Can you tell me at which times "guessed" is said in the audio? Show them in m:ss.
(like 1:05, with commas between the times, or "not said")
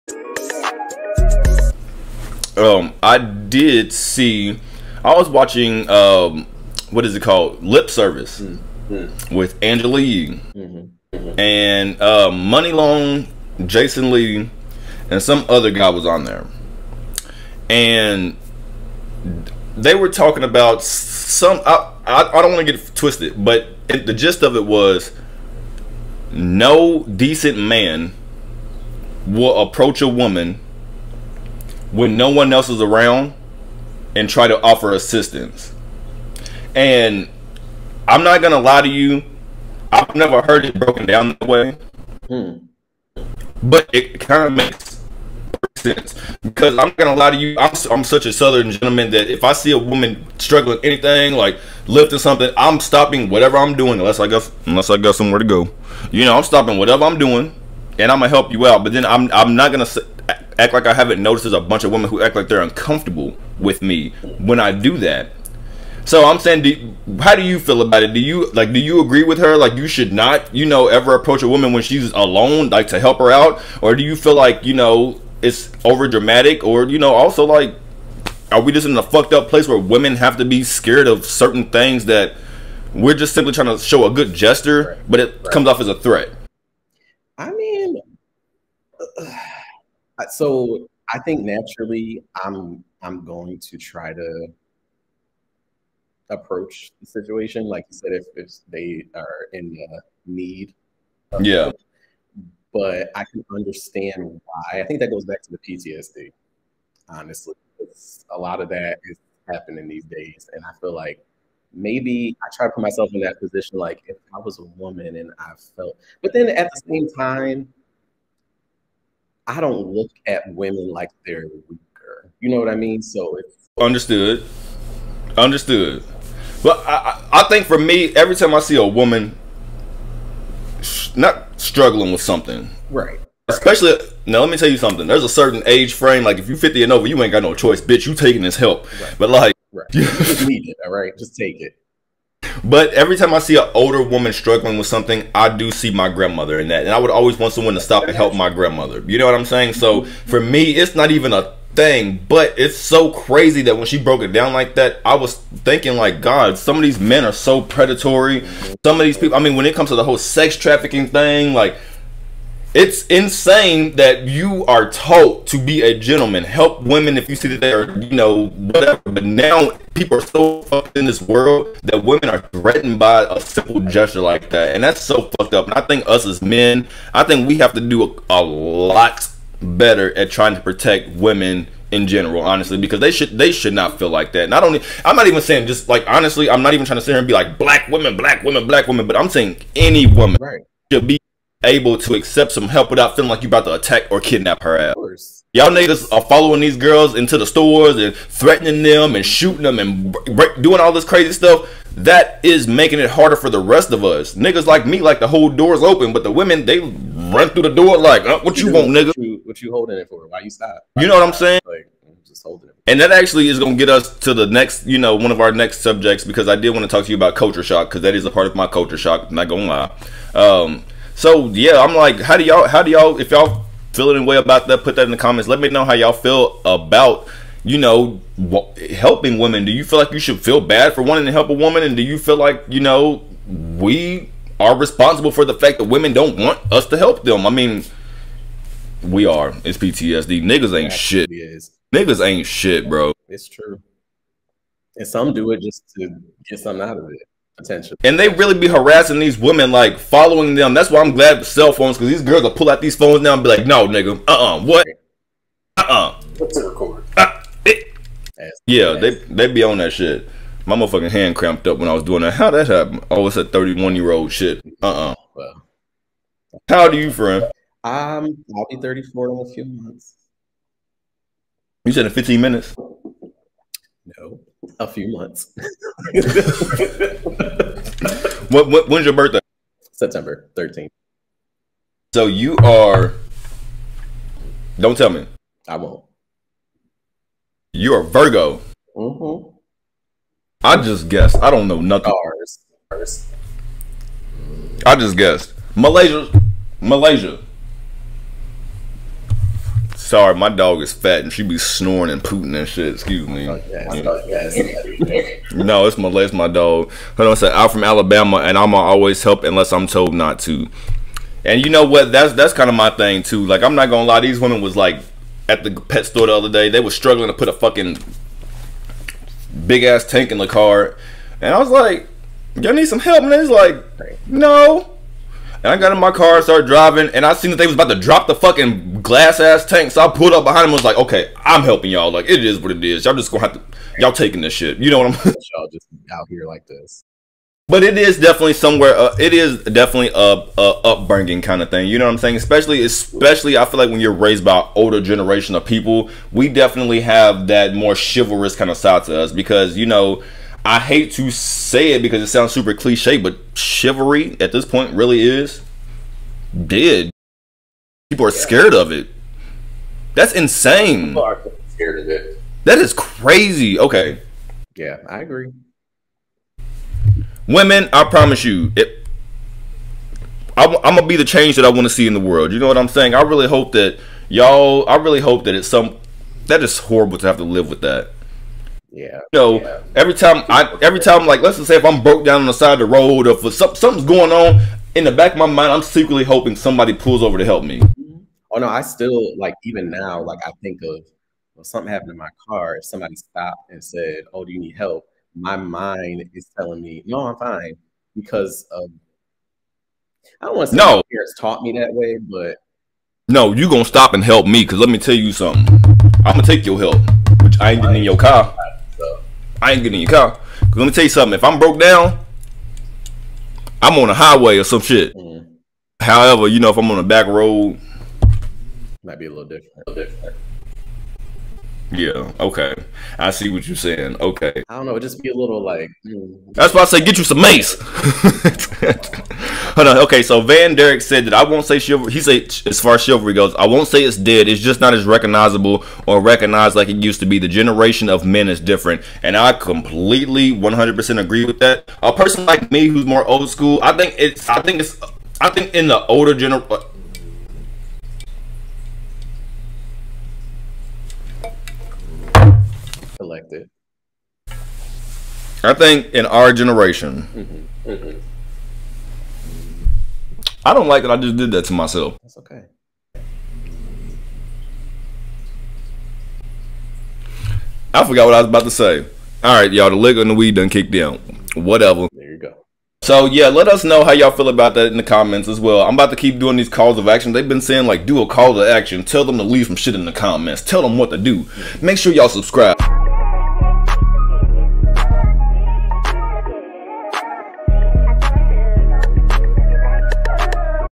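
4:51, 4:55.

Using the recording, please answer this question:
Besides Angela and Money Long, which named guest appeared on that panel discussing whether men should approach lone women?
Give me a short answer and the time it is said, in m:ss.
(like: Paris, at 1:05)
Jason Lee, at 0:13.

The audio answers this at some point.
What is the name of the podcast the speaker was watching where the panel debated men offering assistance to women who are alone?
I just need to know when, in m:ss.
0:07.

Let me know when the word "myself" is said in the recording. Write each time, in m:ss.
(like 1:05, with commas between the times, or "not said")
1:52, 7:41.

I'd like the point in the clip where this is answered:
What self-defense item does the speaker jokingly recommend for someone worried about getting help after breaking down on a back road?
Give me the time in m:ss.
7:07.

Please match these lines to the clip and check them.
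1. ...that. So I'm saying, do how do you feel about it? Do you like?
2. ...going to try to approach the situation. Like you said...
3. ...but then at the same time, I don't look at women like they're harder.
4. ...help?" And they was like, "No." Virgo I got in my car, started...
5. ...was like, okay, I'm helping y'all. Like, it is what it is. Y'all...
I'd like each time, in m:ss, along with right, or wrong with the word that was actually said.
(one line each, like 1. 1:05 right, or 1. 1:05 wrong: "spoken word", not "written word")
1. 1:04 right
2. 1:33 right
3. 1:56 wrong: "weaker", not "harder"
4. 5:22 wrong: "And", not "Virgo"
5. 5:30 right.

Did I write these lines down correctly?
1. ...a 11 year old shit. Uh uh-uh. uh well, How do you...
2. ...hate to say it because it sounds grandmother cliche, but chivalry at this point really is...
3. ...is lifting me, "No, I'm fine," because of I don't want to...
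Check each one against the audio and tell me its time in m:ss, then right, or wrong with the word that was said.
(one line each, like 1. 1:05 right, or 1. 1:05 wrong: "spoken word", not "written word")
1. 4:23 wrong: "31", not "11"
2. 5:50 wrong: "super", not "grandmother"
3. 6:36 wrong: "telling", not "lifting".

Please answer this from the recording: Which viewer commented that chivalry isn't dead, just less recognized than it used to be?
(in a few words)
Van Derek.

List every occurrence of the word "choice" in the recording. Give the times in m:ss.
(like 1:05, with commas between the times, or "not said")
2:17.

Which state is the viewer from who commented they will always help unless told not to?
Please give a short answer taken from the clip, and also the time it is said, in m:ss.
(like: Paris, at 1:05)
Alabama, at 5:07.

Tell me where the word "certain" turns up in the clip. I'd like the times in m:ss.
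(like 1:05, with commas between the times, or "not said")
1:21, 2:15.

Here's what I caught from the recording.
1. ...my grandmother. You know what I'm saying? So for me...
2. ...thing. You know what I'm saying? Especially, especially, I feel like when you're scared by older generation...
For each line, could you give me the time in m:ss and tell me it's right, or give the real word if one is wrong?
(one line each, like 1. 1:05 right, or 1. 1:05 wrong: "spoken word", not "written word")
1. 2:28 right
2. 5:41 wrong: "raised", not "scared".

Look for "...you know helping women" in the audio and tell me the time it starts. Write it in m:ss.
3:47.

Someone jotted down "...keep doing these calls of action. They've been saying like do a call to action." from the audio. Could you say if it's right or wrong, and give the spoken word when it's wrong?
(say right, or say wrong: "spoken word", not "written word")
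right.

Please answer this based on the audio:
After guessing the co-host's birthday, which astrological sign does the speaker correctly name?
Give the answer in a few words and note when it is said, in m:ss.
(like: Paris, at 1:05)
Virgo, at 4:48.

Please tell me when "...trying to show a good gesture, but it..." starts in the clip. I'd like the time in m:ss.
1:23.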